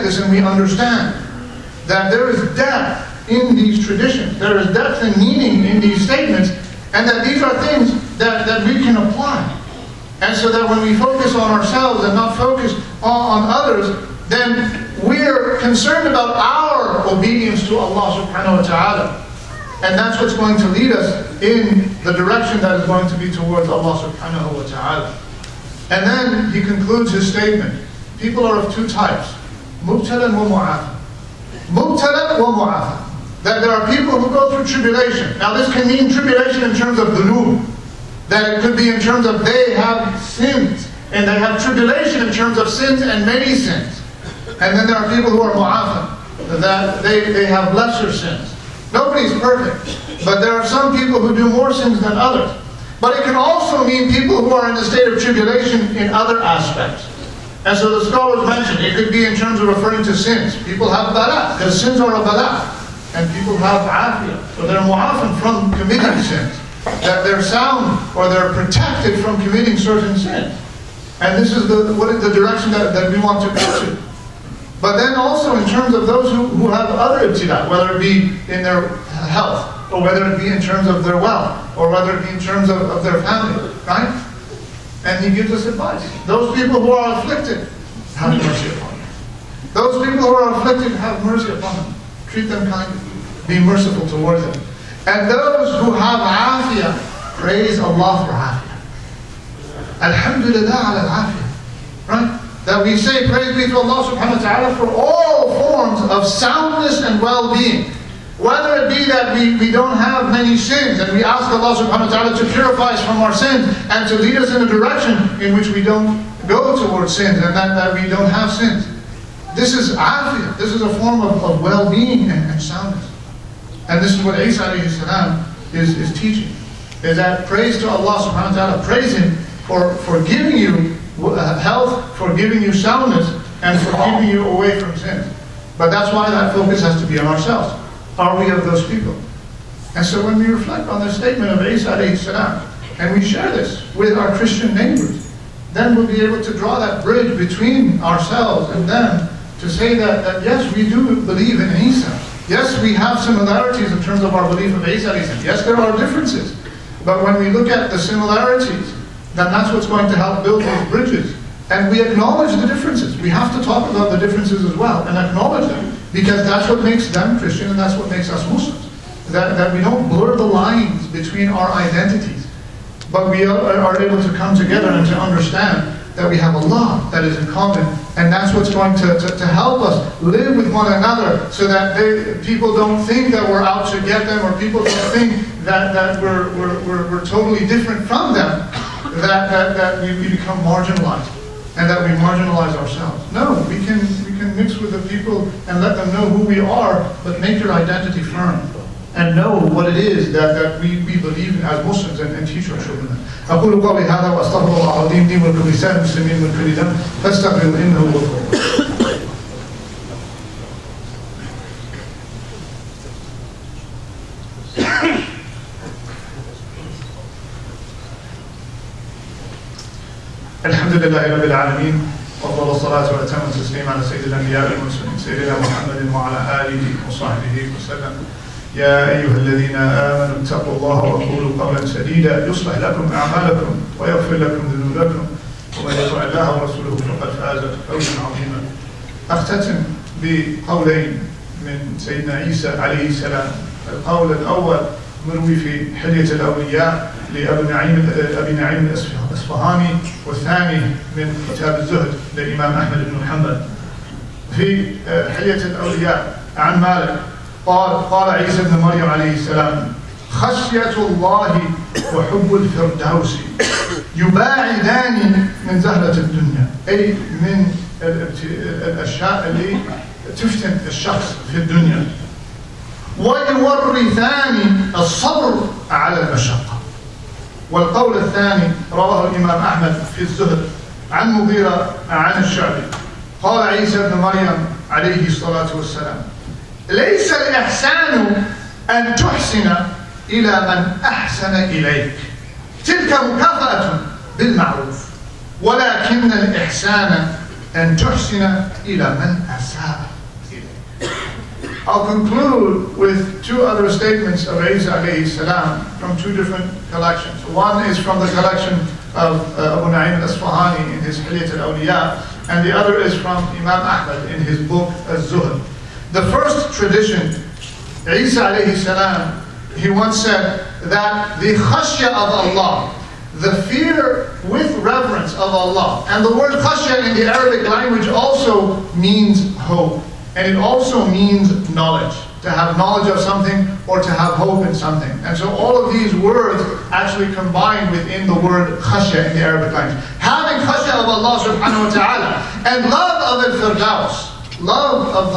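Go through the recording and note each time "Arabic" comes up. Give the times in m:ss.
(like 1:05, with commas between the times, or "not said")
5:27, 5:39.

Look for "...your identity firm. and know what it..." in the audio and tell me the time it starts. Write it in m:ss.
3:17.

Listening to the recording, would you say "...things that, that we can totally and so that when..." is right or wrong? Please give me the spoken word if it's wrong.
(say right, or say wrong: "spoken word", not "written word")
wrong: "apply", not "totally".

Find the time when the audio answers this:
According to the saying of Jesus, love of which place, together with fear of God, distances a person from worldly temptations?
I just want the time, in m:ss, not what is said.
5:43.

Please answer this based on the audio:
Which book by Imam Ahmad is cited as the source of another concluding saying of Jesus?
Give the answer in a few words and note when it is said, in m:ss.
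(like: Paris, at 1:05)
Az-Zuhd, at 5:15.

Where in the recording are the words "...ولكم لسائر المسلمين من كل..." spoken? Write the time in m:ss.
3:25.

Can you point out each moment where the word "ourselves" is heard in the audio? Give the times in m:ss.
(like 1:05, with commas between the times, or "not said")
0:11, 2:17, 2:28, 3:12.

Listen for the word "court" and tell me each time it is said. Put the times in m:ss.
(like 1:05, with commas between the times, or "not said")
not said.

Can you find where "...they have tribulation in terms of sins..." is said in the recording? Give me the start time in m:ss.
0:41.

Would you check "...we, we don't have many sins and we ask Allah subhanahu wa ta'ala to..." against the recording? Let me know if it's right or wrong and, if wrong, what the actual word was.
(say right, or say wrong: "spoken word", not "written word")
right.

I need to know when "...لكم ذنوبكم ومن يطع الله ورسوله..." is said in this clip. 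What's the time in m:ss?
3:54.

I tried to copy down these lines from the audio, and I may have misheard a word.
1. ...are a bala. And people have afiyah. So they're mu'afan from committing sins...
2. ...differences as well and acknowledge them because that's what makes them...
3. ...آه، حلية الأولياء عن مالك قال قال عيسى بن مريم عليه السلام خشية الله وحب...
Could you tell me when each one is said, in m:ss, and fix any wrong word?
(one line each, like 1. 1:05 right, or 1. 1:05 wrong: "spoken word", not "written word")
1. 1:01 right
2. 2:44 right
3. 4:15 right.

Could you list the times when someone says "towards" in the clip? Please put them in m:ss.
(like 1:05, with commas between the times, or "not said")
0:23, 1:34, 1:56.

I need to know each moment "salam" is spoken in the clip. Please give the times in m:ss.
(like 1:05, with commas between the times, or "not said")
5:05, 5:18.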